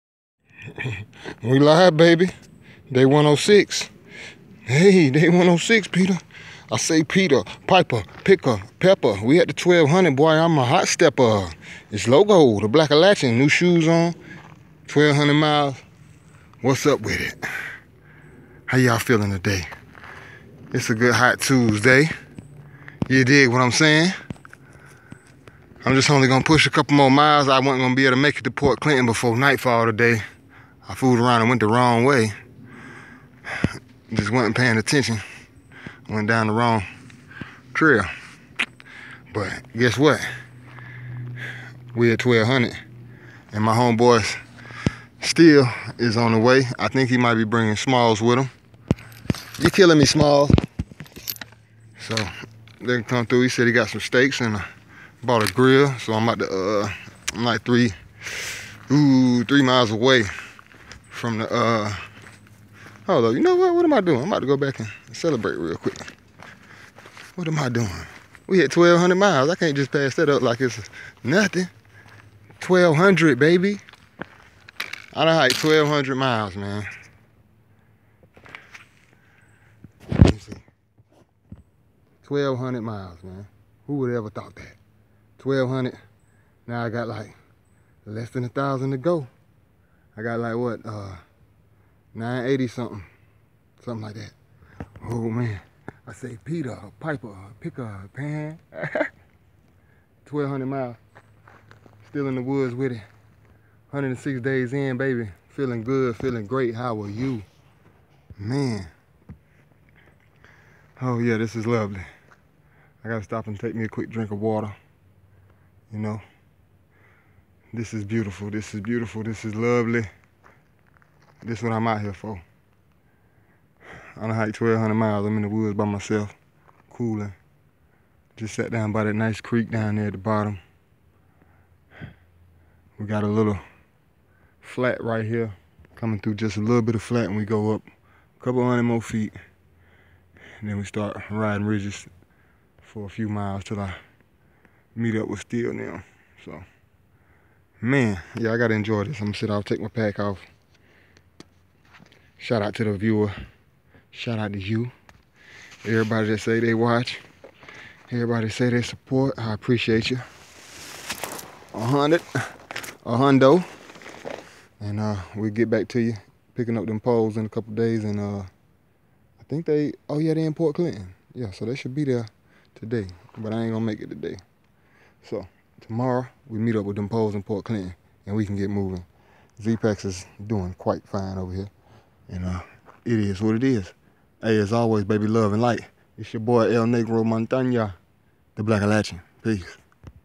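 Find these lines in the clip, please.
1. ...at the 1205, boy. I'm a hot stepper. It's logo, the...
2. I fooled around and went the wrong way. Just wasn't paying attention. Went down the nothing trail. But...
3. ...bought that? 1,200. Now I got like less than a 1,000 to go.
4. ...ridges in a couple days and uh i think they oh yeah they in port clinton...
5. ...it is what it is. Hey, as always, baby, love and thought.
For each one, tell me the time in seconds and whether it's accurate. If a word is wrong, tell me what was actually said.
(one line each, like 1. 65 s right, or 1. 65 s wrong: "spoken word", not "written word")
1. 9 s wrong: "1200", not "1205"
2. 30 s wrong: "wrong", not "nothing"
3. 84 s wrong: "thought", not "bought"
4. 166 s wrong: "poles", not "ridges"
5. 183 s wrong: "light", not "thought".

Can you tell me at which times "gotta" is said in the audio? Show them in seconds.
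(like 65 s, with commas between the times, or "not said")
113 s, 148 s.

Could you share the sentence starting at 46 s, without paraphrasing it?
I think he might be bringing Smalls with him.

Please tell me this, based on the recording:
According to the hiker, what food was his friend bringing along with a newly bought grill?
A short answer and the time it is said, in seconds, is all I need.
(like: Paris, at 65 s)
steaks, at 54 s.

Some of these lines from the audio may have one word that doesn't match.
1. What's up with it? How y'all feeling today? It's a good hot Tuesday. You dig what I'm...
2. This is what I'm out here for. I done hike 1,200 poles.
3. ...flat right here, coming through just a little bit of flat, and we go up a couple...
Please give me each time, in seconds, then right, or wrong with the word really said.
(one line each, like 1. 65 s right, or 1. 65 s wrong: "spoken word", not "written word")
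1. 16 s right
2. 121 s wrong: "miles", not "poles"
3. 134 s right.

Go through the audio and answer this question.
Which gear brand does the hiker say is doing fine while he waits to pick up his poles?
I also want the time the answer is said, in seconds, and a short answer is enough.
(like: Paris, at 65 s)
Zpacks, at 179 s.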